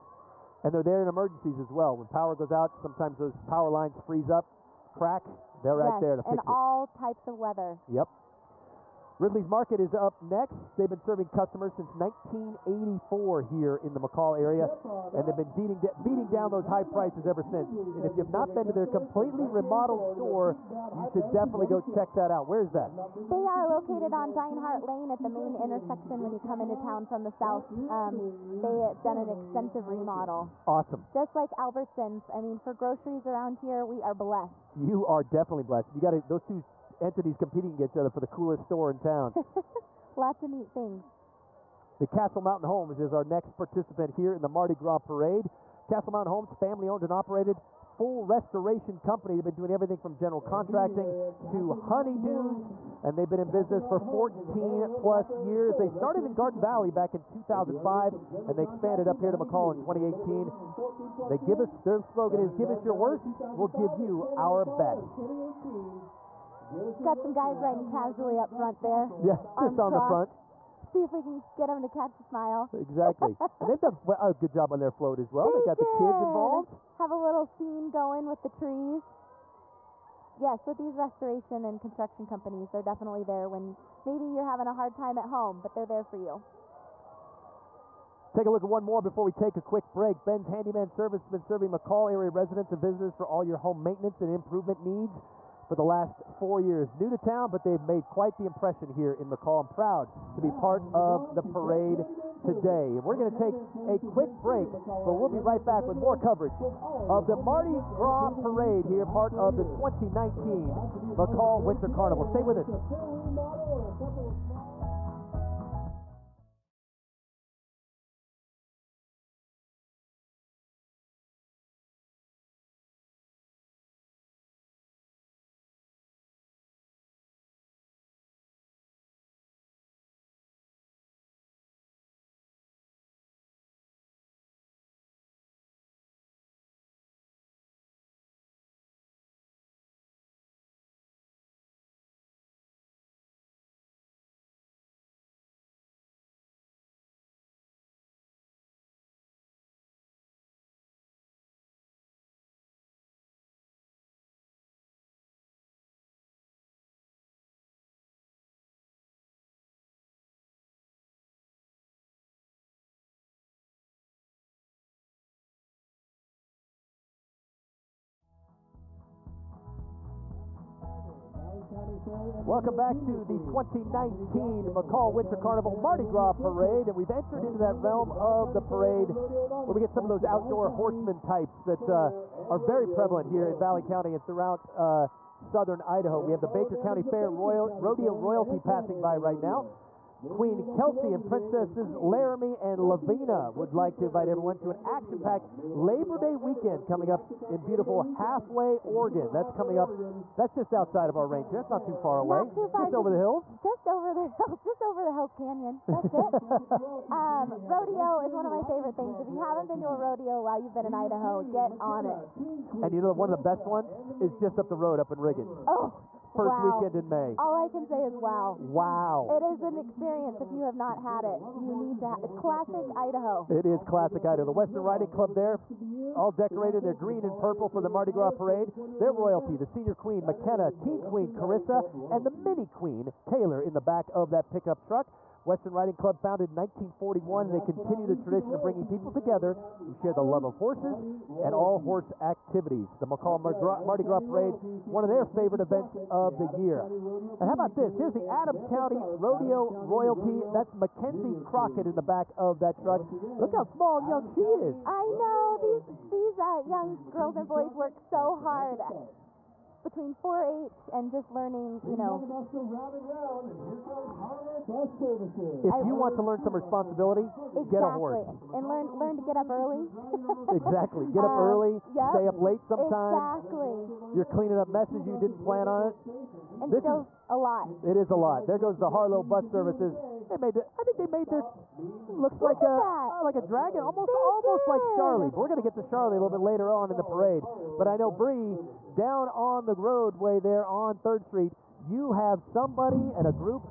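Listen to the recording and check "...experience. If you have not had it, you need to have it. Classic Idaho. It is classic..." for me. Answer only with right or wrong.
right.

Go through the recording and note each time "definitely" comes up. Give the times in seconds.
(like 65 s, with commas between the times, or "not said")
21 s, 35 s, 82 s.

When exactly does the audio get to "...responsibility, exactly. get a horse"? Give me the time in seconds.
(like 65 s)
266 s.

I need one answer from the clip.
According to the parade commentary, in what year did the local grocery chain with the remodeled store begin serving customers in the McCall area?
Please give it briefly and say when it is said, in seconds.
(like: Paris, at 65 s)
1984, at 11 s.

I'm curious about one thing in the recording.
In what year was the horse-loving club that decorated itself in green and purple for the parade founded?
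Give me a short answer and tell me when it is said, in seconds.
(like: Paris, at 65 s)
1941, at 236 s.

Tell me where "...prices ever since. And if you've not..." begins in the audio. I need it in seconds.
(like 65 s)
16 s.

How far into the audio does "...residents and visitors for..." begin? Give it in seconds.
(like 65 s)
92 s.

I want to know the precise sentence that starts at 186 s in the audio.
We have the Baker County Fair Royal, Rodeo Royalty passing by right now.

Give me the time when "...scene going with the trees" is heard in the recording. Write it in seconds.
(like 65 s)
77 s.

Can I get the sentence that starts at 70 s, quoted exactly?
See if we can get them to catch a smile.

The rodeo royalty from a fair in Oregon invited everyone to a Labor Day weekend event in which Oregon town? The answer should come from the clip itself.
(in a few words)
Halfway, Oregon.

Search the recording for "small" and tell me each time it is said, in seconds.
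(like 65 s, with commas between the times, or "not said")
253 s.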